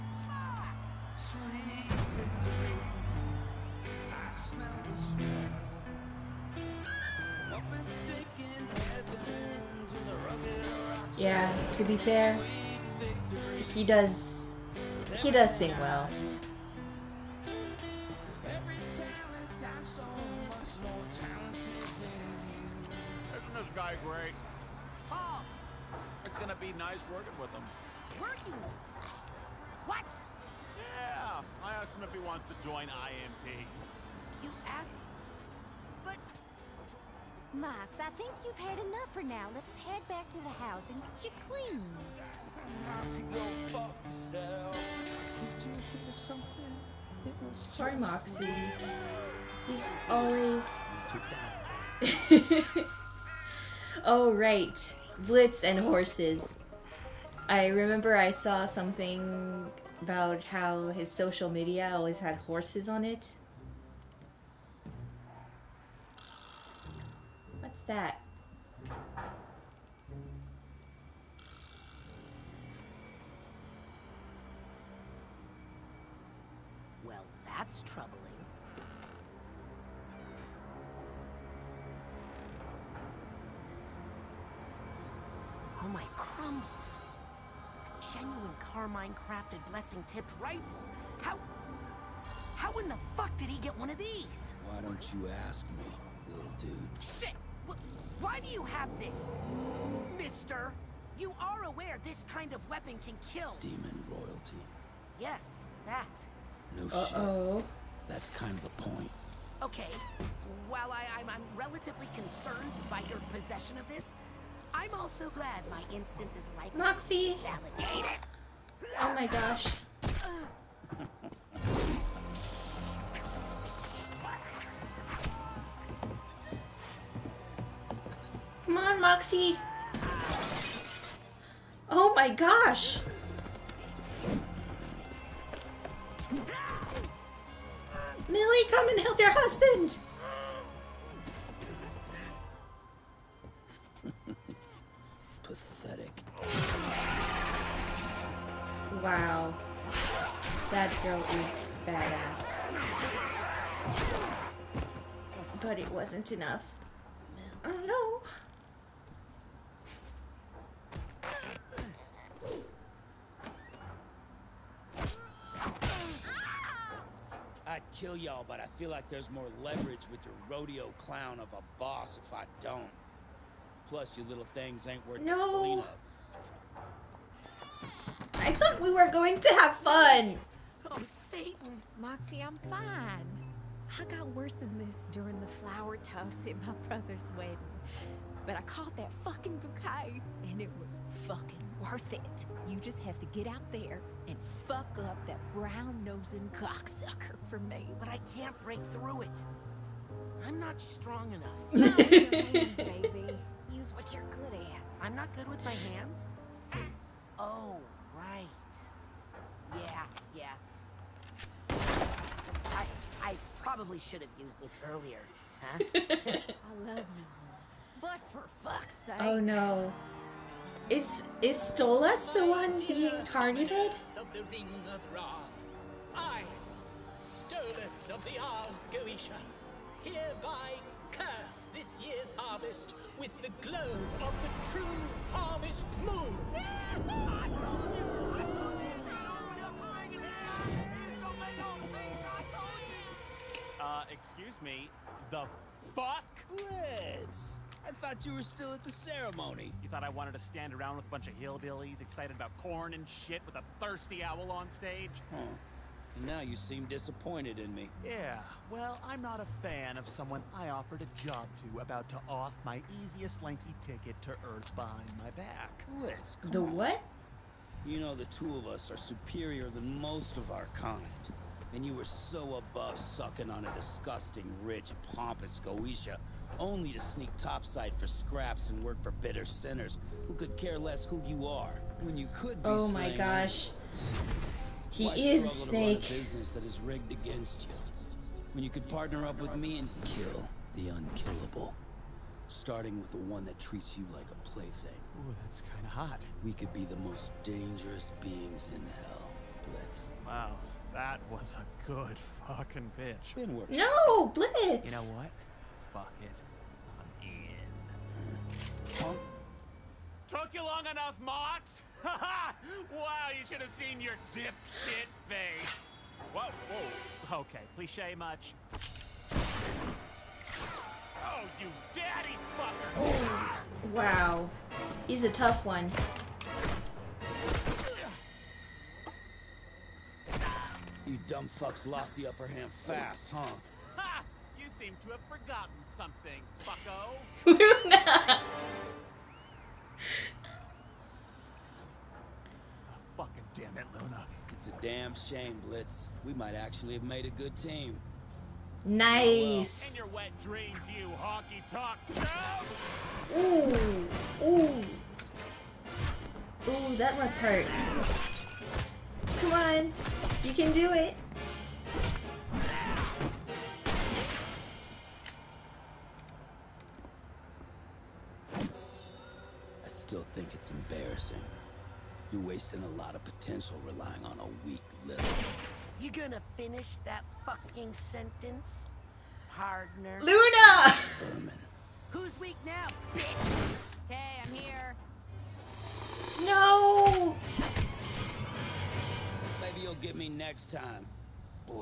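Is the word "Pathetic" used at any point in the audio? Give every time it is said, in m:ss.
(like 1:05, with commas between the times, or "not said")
2:25.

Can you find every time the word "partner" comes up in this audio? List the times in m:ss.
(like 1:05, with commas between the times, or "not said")
4:48, 6:19.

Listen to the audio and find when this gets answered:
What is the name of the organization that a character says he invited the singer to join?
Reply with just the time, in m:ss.
0:32.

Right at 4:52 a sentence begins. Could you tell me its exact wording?
Starting with the one that treats you like a plaything.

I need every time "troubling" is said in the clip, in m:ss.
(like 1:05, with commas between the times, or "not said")
1:17.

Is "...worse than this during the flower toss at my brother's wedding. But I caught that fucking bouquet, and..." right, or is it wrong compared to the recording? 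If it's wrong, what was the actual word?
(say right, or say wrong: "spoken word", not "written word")
right.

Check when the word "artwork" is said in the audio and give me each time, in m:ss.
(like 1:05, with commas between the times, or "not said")
not said.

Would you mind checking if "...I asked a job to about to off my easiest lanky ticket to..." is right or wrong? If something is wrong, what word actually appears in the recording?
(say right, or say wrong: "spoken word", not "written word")
wrong: "offered", not "asked".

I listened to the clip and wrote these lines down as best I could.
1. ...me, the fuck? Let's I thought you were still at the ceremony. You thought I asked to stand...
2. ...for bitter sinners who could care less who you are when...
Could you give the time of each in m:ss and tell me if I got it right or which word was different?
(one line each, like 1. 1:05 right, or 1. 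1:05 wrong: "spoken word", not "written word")
1. 4:04 wrong: "wanted", not "asked"
2. 4:39 right.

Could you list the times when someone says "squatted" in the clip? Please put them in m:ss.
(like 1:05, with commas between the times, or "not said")
not said.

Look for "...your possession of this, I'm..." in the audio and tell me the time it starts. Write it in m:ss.
1:53.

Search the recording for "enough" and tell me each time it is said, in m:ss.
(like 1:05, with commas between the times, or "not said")
0:38, 2:36, 3:21, 5:10.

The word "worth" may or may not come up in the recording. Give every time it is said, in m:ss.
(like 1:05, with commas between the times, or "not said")
2:55, 3:11.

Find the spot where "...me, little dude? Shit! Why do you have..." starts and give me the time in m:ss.
1:35.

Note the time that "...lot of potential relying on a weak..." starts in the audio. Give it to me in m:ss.
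6:12.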